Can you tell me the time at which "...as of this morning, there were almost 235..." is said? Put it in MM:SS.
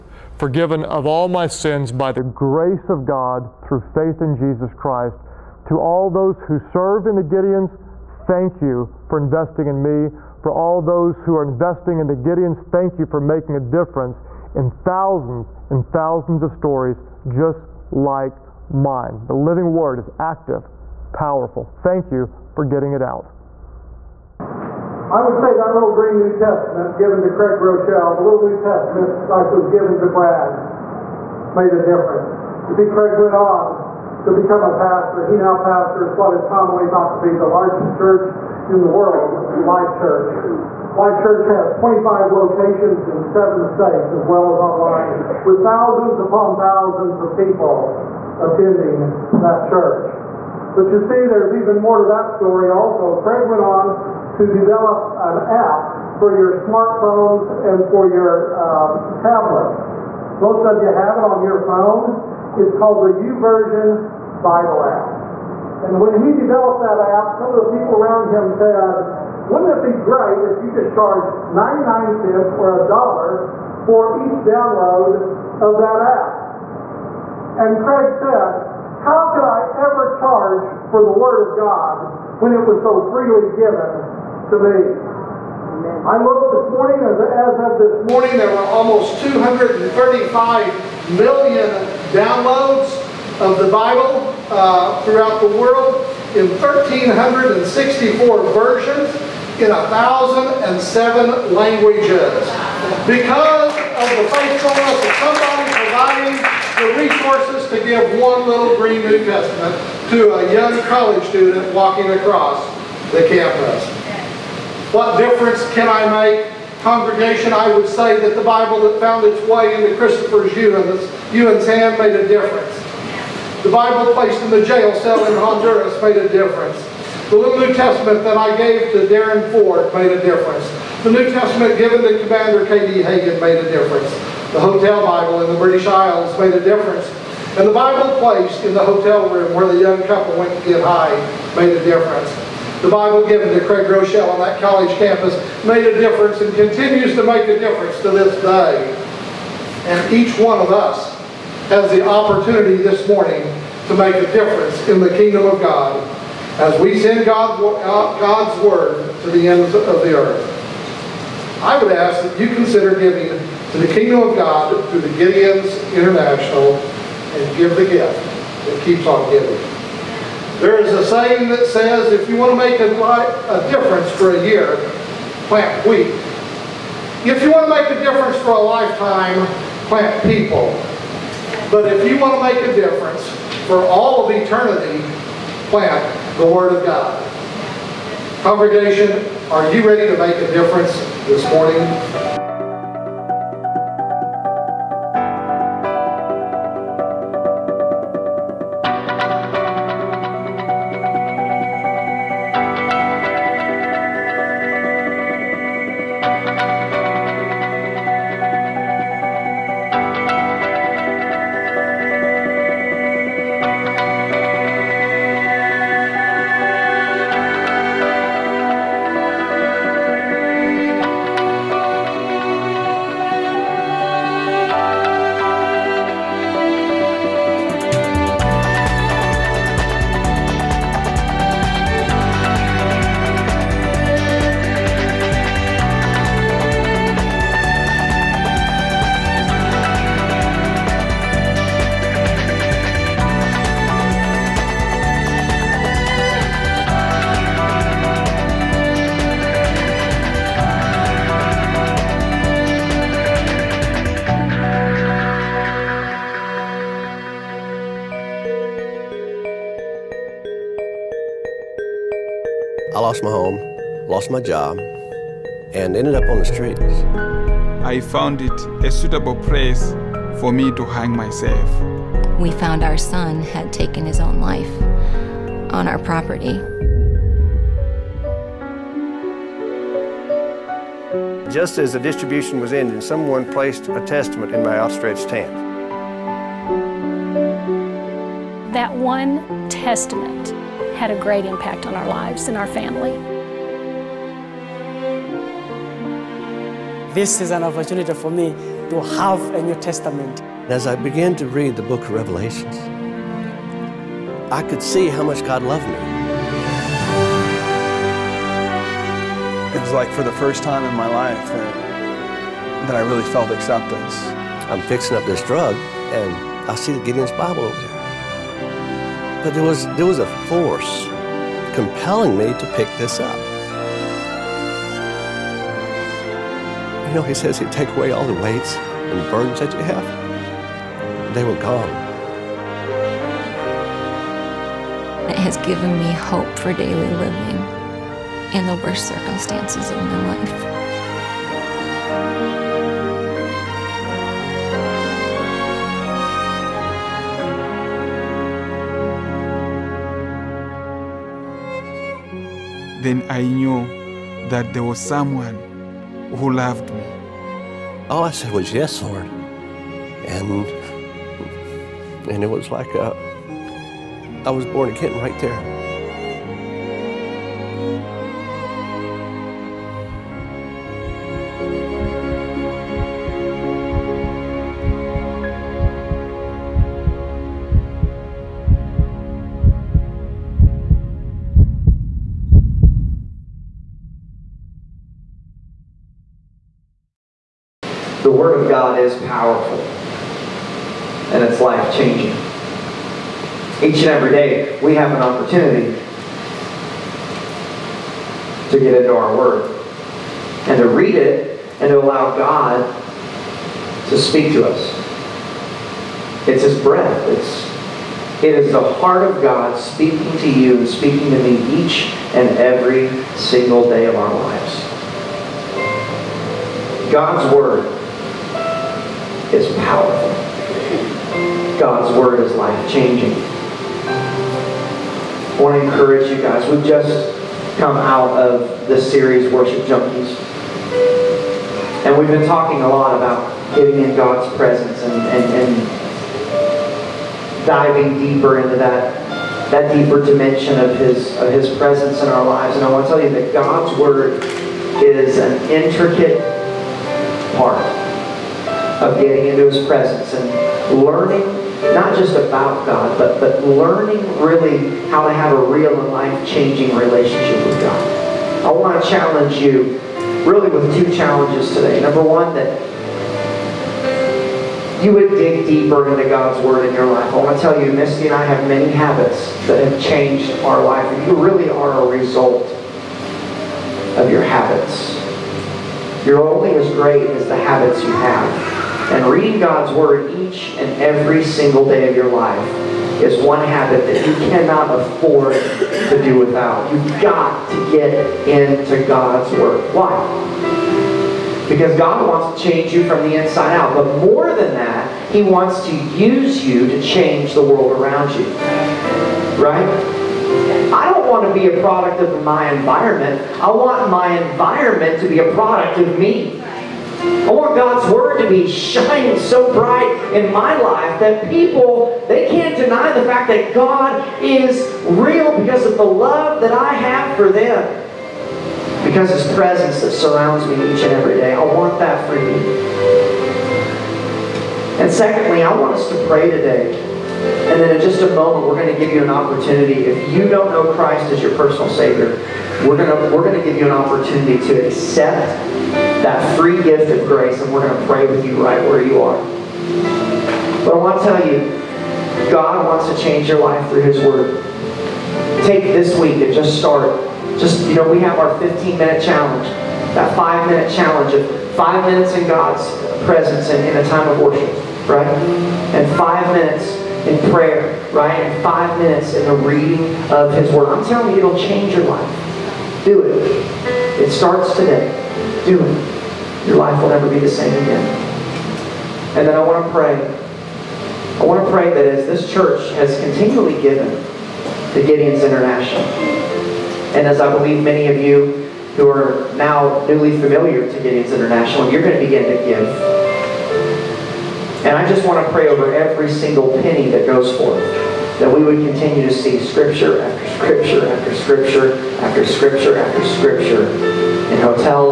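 01:26.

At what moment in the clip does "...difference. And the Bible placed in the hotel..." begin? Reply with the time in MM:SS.
02:16.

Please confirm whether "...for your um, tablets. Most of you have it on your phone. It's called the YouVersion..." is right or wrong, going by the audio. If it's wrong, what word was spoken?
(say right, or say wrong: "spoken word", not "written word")
right.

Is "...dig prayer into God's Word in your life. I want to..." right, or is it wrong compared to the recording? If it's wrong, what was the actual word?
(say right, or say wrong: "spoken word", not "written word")
wrong: "deeper", not "prayer".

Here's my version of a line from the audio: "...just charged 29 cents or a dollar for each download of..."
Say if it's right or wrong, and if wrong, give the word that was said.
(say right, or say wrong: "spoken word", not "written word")
wrong: "99", not "29".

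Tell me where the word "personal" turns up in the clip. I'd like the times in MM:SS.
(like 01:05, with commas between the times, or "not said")
08:51.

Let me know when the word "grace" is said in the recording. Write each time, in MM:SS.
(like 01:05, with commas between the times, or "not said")
00:02, 08:57.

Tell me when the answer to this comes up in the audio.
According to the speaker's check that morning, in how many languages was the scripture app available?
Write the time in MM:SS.
01:39.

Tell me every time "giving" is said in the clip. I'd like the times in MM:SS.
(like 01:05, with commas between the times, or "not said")
02:42, 02:49.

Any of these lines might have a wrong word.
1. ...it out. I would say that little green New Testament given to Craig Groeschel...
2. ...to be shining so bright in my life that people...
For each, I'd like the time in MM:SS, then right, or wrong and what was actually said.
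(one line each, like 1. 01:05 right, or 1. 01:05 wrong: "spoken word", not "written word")
1. 00:22 right
2. 08:28 right.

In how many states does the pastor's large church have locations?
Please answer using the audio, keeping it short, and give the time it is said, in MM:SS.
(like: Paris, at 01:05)
7, at 00:43.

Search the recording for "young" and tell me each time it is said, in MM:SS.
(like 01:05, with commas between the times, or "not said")
01:50, 02:19.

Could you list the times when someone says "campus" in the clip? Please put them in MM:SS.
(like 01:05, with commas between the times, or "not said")
01:53, 02:24.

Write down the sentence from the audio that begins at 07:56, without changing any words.
You're only as great as the habits you have.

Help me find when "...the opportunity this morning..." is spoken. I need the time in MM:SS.
02:31.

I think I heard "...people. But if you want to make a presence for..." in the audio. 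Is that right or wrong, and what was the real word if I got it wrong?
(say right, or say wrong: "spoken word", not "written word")
wrong: "difference", not "presence".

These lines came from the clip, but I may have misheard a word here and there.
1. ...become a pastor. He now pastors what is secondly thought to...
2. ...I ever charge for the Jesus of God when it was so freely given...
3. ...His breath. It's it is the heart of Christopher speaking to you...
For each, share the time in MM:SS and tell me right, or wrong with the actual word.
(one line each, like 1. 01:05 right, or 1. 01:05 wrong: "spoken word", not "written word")
1. 00:34 wrong: "commonly", not "secondly"
2. 01:19 wrong: "Word", not "Jesus"
3. 06:46 wrong: "God", not "Christopher".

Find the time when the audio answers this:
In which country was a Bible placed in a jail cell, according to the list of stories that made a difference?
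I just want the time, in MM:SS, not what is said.
02:05.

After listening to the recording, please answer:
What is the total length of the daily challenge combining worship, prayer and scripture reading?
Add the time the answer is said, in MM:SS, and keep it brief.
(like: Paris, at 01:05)
15 minutes, at 09:08.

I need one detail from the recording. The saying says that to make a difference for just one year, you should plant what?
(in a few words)
Wheat.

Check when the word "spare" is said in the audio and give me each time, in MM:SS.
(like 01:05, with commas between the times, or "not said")
not said.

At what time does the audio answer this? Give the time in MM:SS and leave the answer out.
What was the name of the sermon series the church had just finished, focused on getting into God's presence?
07:09.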